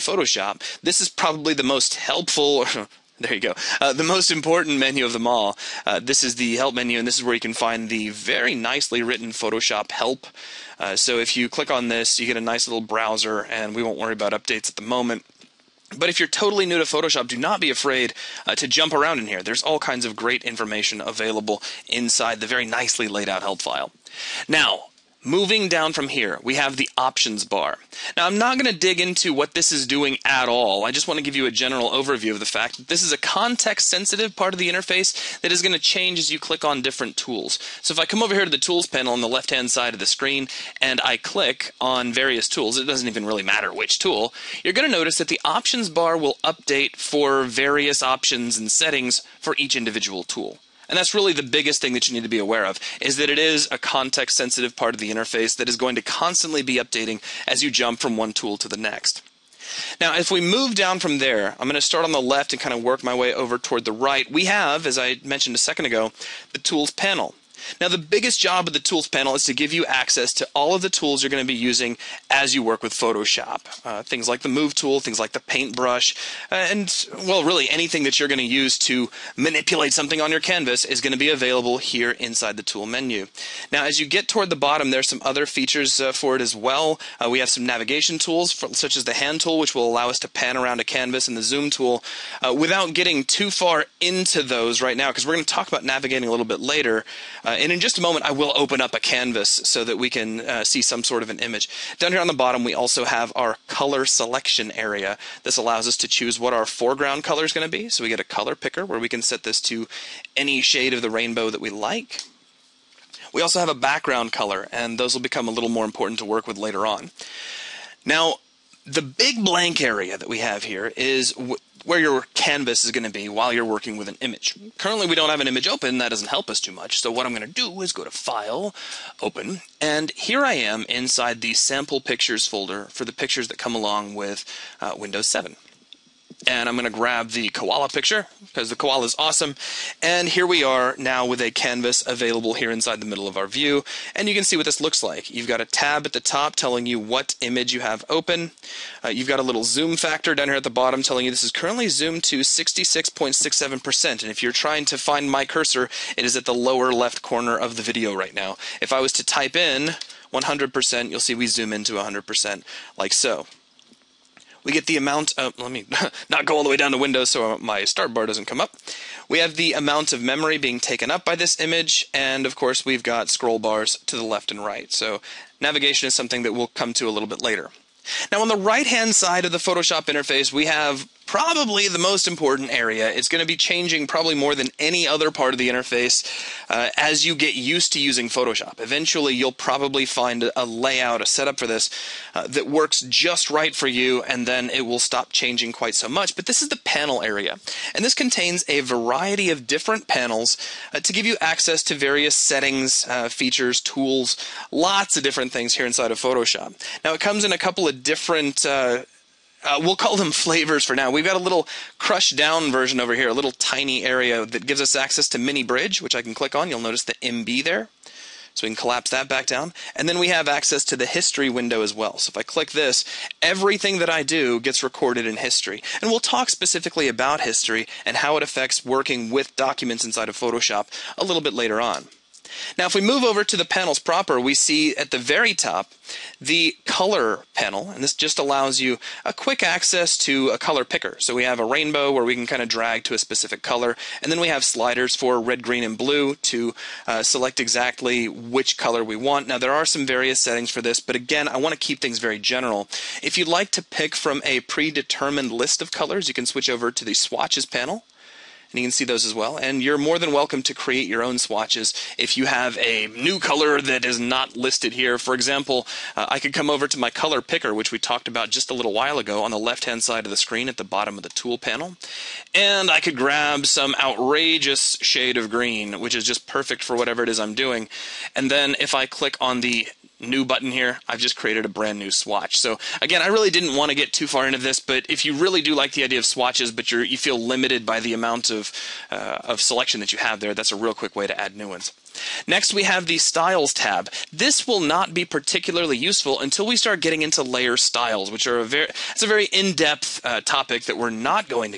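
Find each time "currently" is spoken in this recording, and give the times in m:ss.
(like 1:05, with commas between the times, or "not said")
2:04, 2:31.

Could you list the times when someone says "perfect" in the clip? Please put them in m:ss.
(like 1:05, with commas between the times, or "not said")
4:36.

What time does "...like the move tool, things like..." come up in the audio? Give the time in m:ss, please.
1:14.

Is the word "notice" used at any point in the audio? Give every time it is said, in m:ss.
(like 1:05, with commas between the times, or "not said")
0:44, 3:36.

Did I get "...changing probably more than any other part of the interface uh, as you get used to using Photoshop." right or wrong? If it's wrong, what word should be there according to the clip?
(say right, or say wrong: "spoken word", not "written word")
right.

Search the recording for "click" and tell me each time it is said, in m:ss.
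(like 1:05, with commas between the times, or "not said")
0:11, 0:36, 0:41, 3:36, 3:42, 4:39.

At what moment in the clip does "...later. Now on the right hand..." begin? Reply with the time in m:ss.
2:57.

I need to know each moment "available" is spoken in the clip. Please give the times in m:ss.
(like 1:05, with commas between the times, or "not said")
0:21, 1:21, 2:22.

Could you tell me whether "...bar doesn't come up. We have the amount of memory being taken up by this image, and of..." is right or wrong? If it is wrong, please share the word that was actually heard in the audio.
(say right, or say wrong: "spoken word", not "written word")
right.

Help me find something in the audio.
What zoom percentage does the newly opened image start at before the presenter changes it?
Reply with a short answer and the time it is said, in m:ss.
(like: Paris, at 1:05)
66.67%, at 2:32.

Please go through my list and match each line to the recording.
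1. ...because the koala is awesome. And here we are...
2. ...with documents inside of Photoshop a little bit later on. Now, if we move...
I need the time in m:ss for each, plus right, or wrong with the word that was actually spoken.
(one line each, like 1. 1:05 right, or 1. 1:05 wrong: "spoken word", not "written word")
1. 2:18 right
2. 3:49 right.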